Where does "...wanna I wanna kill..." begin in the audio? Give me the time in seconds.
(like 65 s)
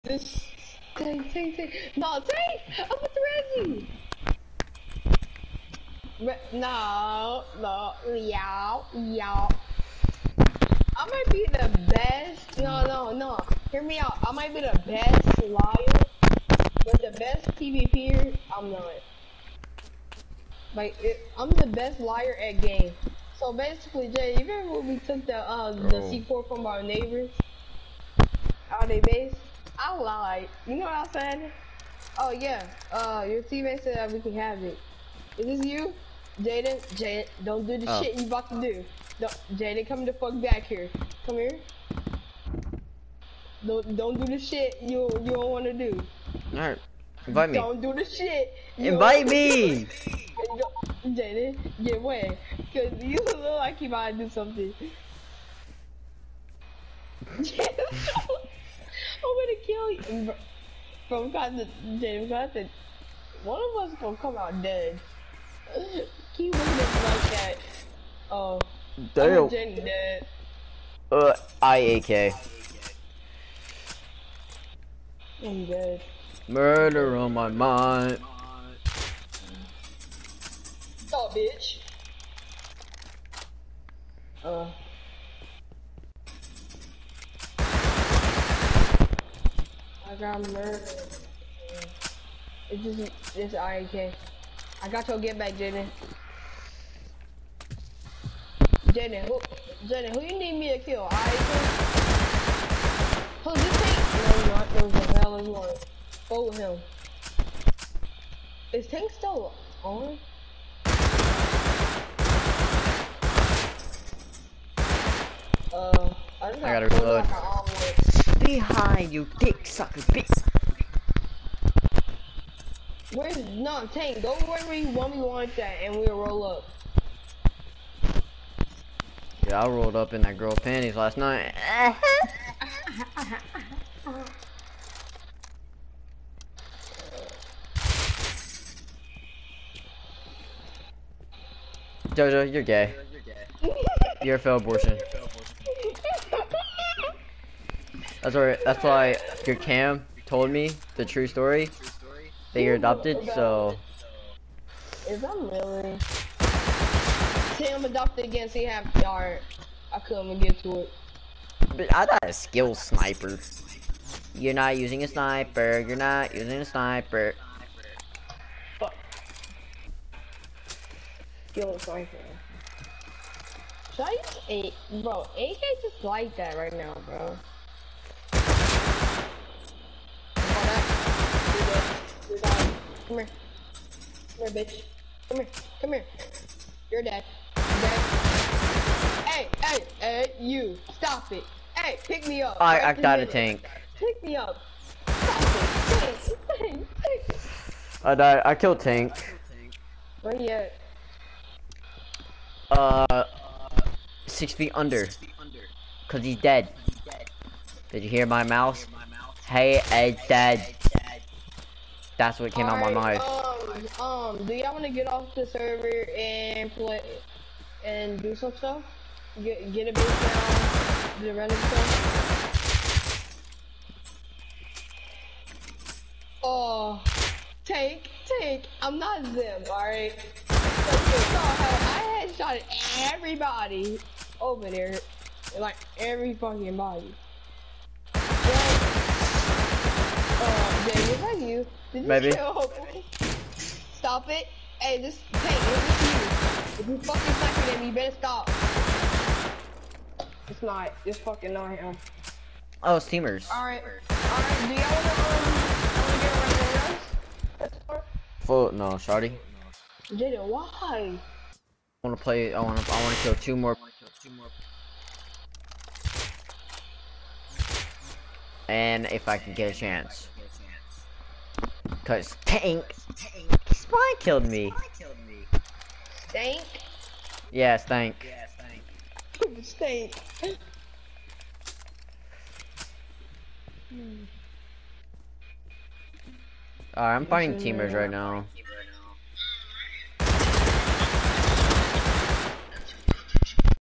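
262 s.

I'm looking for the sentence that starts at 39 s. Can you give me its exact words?
Don't, Jaden, come the fuck back here.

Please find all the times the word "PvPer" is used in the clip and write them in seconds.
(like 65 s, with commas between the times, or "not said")
17 s.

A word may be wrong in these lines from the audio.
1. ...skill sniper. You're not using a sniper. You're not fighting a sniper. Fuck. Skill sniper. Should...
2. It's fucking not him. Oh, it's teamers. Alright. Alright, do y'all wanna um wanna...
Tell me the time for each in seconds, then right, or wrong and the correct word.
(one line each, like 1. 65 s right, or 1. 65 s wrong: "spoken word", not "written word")
1. 162 s wrong: "using", not "fighting"
2. 251 s right.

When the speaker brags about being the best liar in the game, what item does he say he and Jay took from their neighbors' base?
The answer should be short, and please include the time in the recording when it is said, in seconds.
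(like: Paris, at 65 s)
C4, at 26 s.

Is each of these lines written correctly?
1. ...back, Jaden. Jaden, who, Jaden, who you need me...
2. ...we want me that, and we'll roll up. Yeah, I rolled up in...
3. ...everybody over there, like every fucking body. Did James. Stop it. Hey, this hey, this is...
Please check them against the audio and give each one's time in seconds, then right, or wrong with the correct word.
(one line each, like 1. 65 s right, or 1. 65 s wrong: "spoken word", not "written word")
1. 95 s right
2. 124 s right
3. 233 s wrong: "Maybe", not "James".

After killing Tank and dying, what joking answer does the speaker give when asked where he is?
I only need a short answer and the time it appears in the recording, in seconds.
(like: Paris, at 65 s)
six feet under, at 204 s.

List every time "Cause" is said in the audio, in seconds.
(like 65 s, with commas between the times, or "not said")
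52 s, 206 s, 272 s.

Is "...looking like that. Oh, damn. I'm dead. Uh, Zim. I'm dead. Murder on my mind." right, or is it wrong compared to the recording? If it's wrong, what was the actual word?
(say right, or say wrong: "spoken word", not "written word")
wrong: "IAK", not "Zim".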